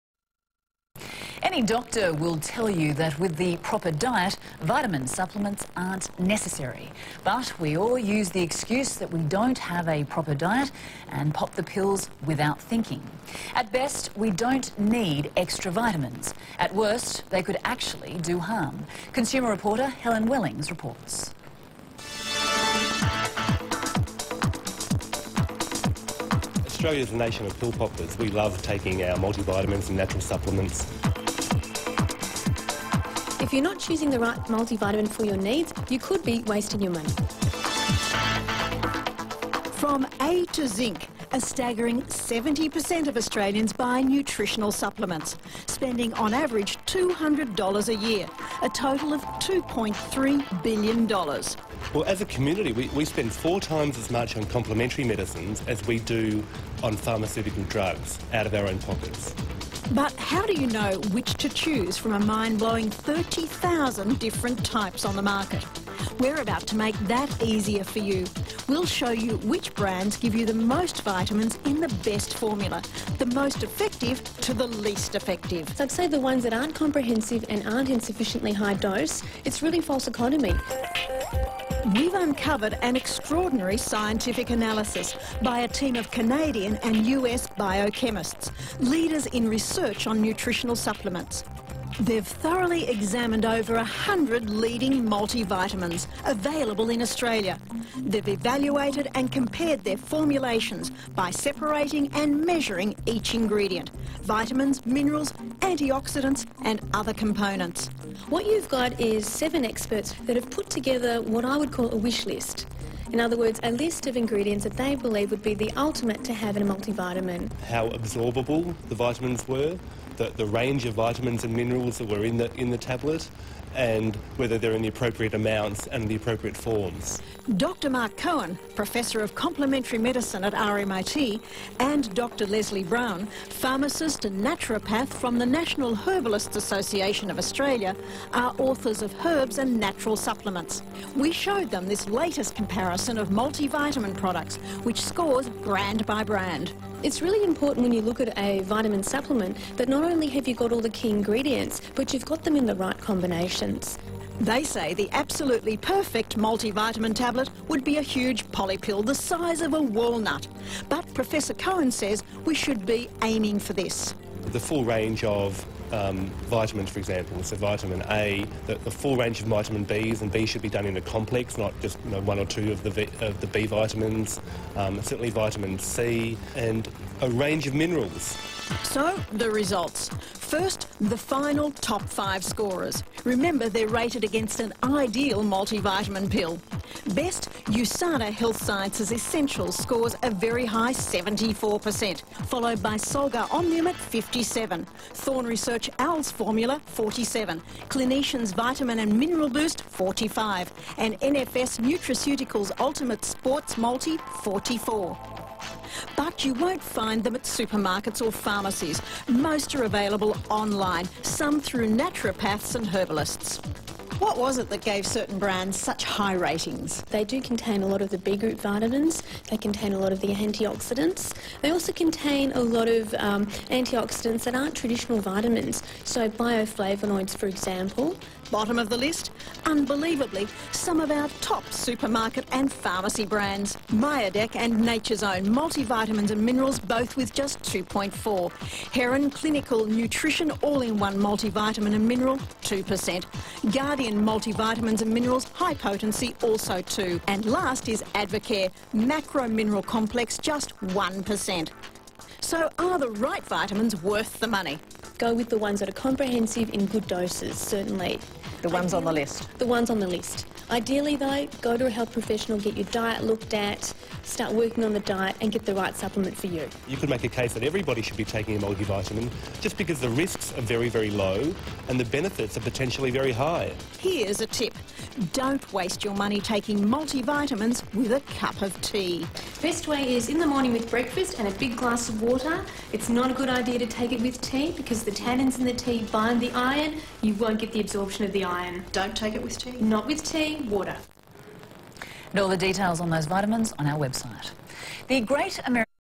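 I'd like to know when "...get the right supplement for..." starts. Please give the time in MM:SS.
04:25.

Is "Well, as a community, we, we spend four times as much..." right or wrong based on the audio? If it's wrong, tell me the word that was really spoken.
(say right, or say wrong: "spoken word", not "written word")
right.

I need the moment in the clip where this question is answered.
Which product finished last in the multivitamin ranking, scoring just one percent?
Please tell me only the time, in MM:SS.
04:08.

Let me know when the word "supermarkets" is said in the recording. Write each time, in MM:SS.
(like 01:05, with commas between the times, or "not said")
03:27, 03:51.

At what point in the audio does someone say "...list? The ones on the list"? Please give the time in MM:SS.
04:19.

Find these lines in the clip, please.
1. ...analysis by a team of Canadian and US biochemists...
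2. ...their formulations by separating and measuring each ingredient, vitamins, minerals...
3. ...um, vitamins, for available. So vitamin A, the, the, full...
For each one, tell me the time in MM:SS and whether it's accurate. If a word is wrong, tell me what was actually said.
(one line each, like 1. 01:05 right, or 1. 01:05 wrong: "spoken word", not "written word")
1. 01:24 right
2. 01:39 right
3. 02:45 wrong: "example", not "available".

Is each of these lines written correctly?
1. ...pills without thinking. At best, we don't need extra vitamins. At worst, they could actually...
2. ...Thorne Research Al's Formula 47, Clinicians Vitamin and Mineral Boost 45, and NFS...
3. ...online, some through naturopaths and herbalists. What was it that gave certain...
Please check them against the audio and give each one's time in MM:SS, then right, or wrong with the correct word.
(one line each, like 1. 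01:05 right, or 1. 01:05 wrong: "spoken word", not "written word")
1. 00:11 right
2. 03:15 right
3. 03:30 right.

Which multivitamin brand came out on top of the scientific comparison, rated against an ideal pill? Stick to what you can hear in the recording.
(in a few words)
Usana Health Sciences Essentials.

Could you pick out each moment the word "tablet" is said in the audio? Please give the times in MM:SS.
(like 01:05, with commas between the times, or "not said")
02:02, 02:37.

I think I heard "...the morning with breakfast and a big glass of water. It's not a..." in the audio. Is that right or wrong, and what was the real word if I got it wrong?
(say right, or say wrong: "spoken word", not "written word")
right.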